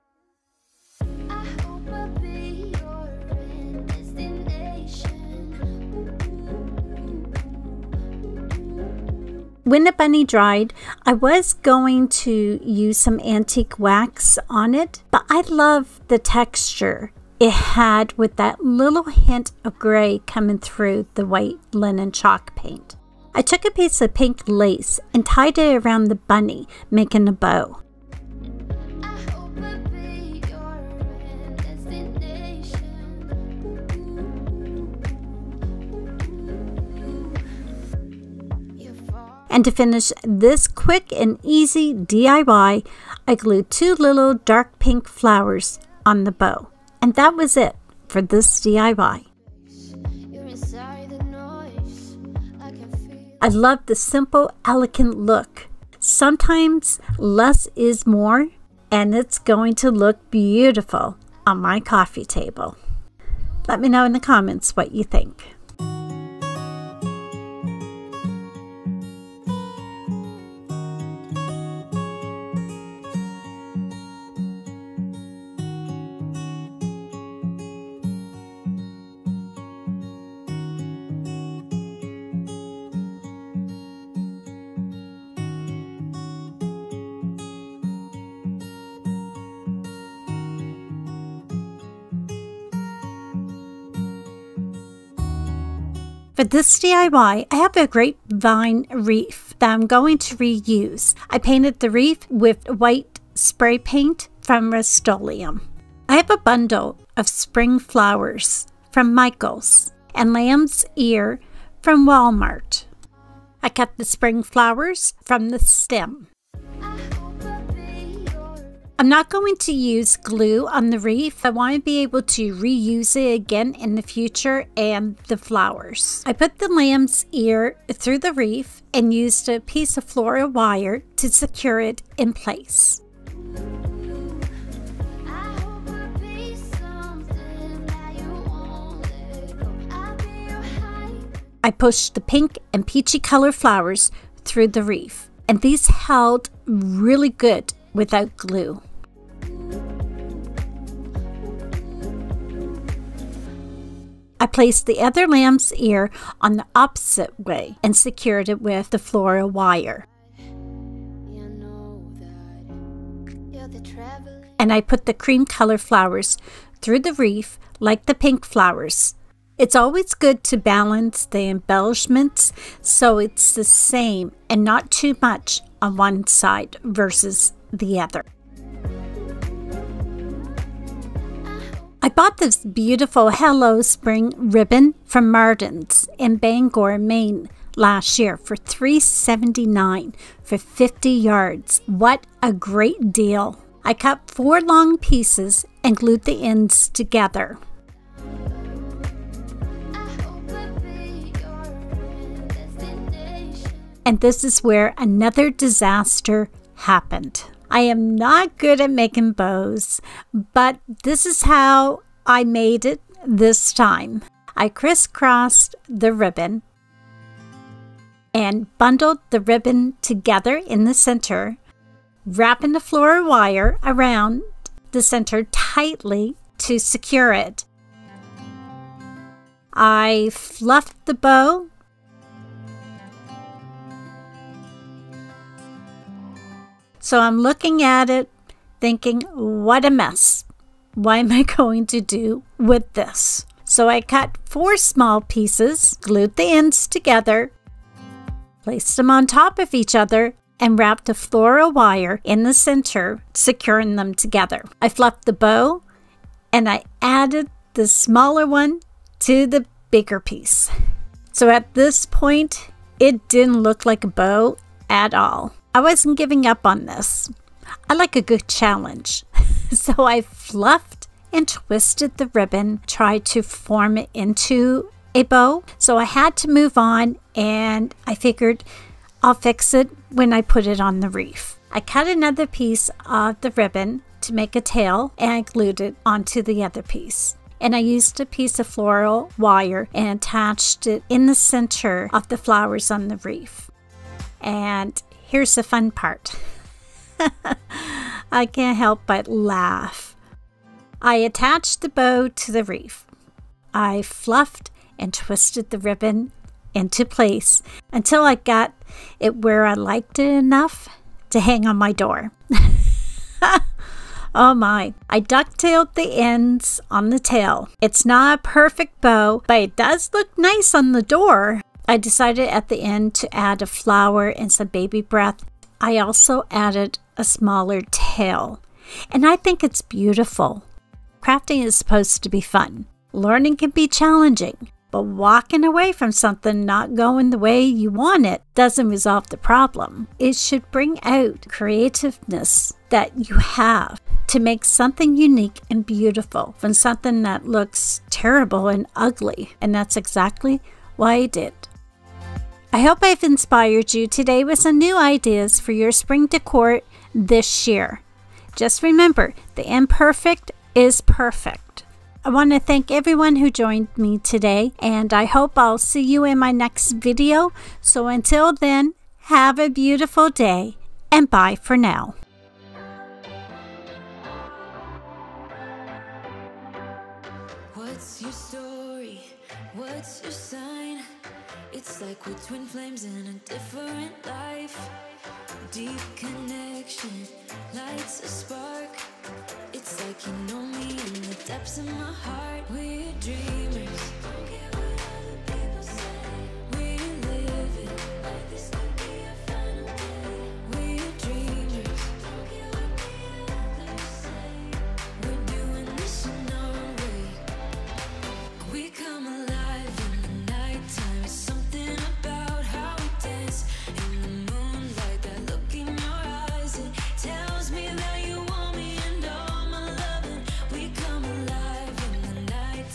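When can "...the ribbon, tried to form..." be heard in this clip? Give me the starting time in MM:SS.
04:32.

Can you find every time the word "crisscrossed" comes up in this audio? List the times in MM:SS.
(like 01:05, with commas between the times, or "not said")
03:34.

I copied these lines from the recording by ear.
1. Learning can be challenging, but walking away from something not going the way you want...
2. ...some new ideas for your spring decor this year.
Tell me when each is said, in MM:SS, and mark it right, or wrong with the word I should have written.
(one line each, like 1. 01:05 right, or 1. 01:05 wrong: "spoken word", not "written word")
1. 05:33 right
2. 05:54 right.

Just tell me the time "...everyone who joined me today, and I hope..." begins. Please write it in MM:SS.
06:02.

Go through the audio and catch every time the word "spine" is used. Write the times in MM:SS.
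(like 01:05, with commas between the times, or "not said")
not said.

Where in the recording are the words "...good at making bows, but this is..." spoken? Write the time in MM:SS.
03:28.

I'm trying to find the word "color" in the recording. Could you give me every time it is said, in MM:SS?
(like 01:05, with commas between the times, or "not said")
02:23, 02:45.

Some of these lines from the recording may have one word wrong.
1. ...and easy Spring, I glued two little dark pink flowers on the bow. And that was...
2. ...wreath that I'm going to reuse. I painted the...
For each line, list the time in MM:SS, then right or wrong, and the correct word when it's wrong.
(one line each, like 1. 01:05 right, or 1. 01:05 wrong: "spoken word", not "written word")
1. 00:41 wrong: "DIY", not "Spring"
2. 01:38 right.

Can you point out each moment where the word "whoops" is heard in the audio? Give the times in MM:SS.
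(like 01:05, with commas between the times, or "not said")
not said.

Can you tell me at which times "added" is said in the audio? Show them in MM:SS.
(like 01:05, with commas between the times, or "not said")
04:17, 05:26.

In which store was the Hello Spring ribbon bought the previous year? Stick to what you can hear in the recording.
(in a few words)
Martin's.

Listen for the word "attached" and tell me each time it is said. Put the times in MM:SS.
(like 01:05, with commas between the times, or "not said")
04:50, 05:01.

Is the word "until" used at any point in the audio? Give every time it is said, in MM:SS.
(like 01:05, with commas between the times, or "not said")
05:07, 06:08.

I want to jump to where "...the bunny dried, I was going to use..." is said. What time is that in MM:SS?
00:09.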